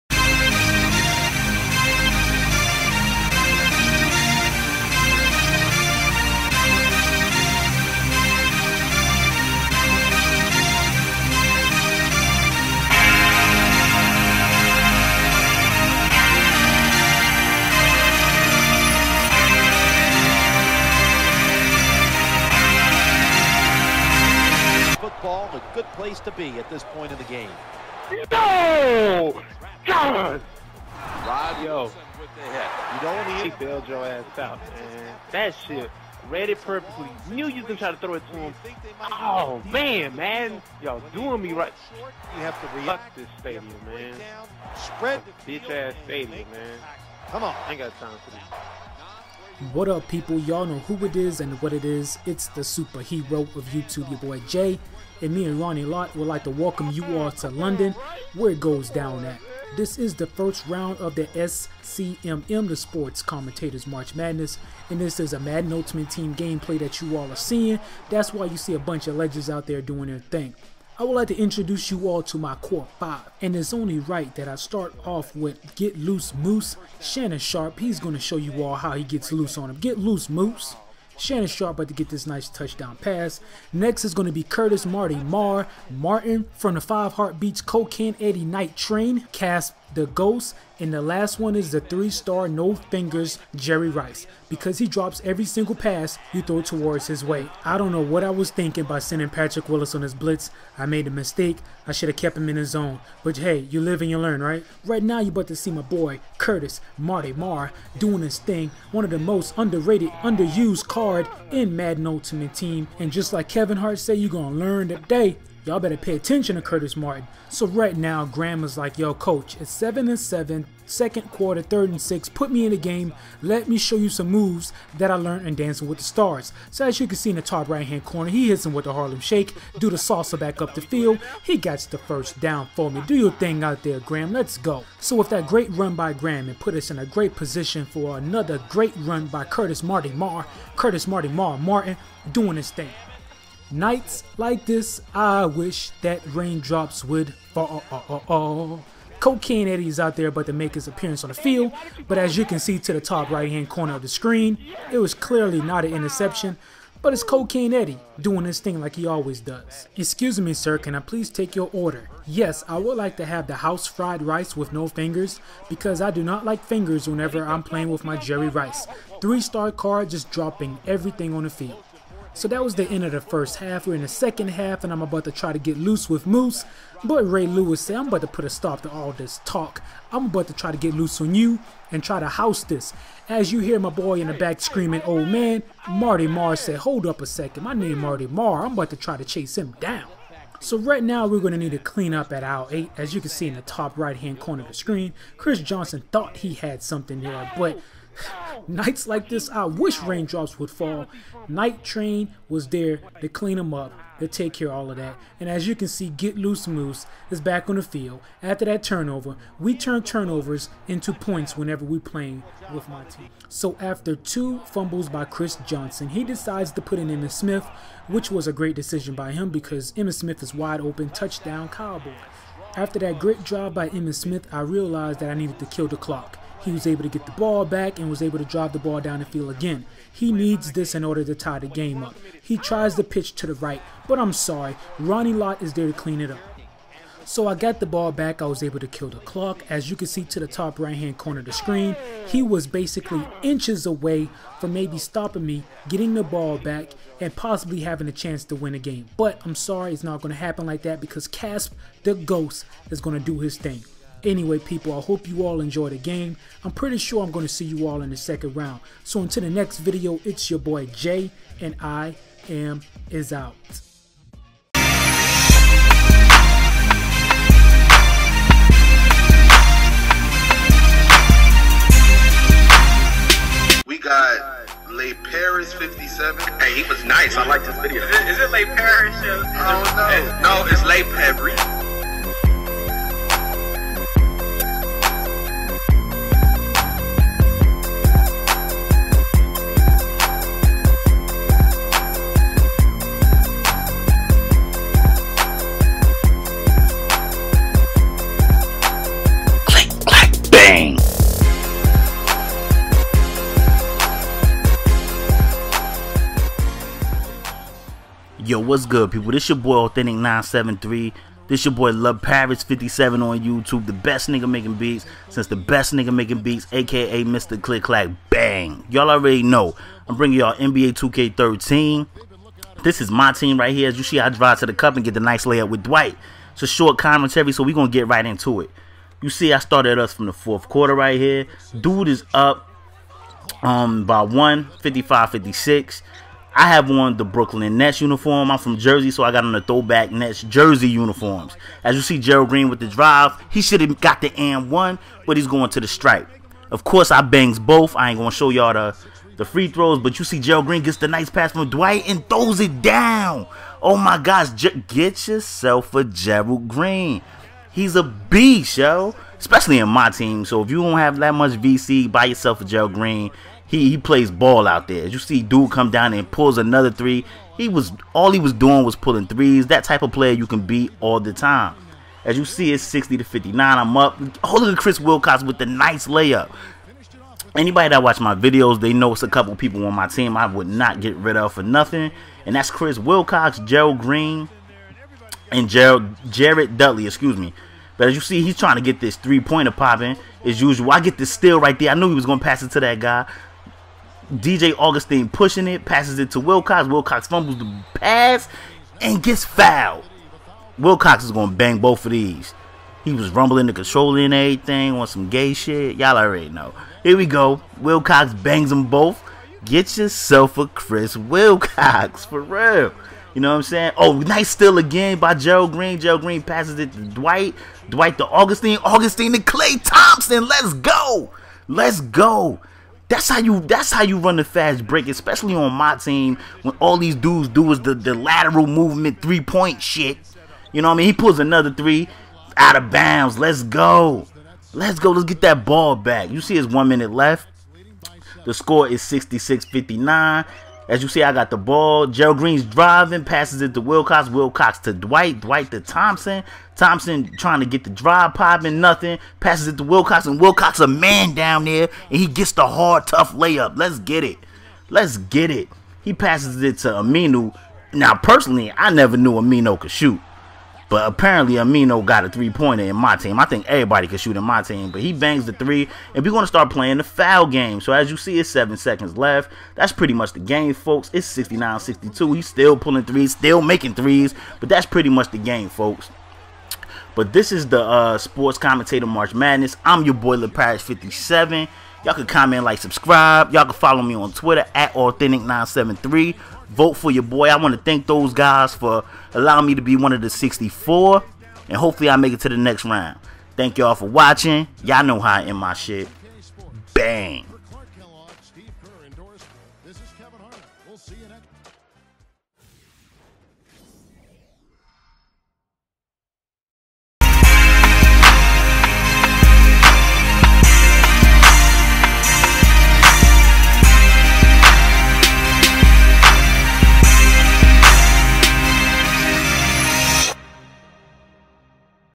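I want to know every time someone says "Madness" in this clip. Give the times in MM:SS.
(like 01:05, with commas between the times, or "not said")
01:04, 07:59.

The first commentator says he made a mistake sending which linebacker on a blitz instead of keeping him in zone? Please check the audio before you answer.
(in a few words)
Patrick Willis.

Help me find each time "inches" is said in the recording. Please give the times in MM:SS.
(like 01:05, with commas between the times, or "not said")
04:03.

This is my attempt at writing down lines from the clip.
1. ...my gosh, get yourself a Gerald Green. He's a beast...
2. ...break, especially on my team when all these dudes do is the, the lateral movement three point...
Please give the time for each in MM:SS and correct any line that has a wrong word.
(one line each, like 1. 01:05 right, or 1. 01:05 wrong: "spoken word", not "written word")
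1. 05:53 right
2. 07:04 right.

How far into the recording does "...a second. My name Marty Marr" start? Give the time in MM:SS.
03:07.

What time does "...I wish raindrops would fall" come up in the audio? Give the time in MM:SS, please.
03:19.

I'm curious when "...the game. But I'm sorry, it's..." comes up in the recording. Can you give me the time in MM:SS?
04:08.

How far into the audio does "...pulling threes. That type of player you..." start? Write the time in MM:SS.
06:08.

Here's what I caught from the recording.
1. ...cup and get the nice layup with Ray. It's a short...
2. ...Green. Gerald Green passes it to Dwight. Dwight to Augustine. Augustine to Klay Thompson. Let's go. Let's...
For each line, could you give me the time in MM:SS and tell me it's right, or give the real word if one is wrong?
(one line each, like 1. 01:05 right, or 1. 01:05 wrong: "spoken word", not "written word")
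1. 05:24 wrong: "Dwight", not "Ray"
2. 06:55 right.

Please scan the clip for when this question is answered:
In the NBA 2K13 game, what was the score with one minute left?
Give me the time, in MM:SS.
07:19.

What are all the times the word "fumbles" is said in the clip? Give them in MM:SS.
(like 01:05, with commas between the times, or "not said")
03:34, 06:37.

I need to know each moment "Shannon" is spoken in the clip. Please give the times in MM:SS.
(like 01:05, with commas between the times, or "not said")
01:16, 01:21.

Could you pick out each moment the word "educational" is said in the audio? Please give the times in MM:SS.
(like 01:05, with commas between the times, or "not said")
not said.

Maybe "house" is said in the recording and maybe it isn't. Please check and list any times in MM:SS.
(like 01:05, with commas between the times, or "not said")
02:43, 03:02.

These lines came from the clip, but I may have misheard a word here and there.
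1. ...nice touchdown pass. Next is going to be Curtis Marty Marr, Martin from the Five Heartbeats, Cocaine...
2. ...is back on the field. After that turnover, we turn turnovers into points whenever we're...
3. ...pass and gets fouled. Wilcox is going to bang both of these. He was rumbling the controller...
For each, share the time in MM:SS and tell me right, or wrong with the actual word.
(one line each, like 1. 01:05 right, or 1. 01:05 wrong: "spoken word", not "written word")
1. 01:22 right
2. 03:27 right
3. 06:37 right.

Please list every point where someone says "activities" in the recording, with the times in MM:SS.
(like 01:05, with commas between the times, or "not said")
not said.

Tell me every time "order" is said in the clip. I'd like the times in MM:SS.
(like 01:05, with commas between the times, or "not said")
02:41, 03:51.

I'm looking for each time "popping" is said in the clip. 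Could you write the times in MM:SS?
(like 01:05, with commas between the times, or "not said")
06:29, 07:28.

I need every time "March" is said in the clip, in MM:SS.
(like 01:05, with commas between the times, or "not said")
01:03, 07:59.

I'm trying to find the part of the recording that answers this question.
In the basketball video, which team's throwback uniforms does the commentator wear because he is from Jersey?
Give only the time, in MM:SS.
05:37.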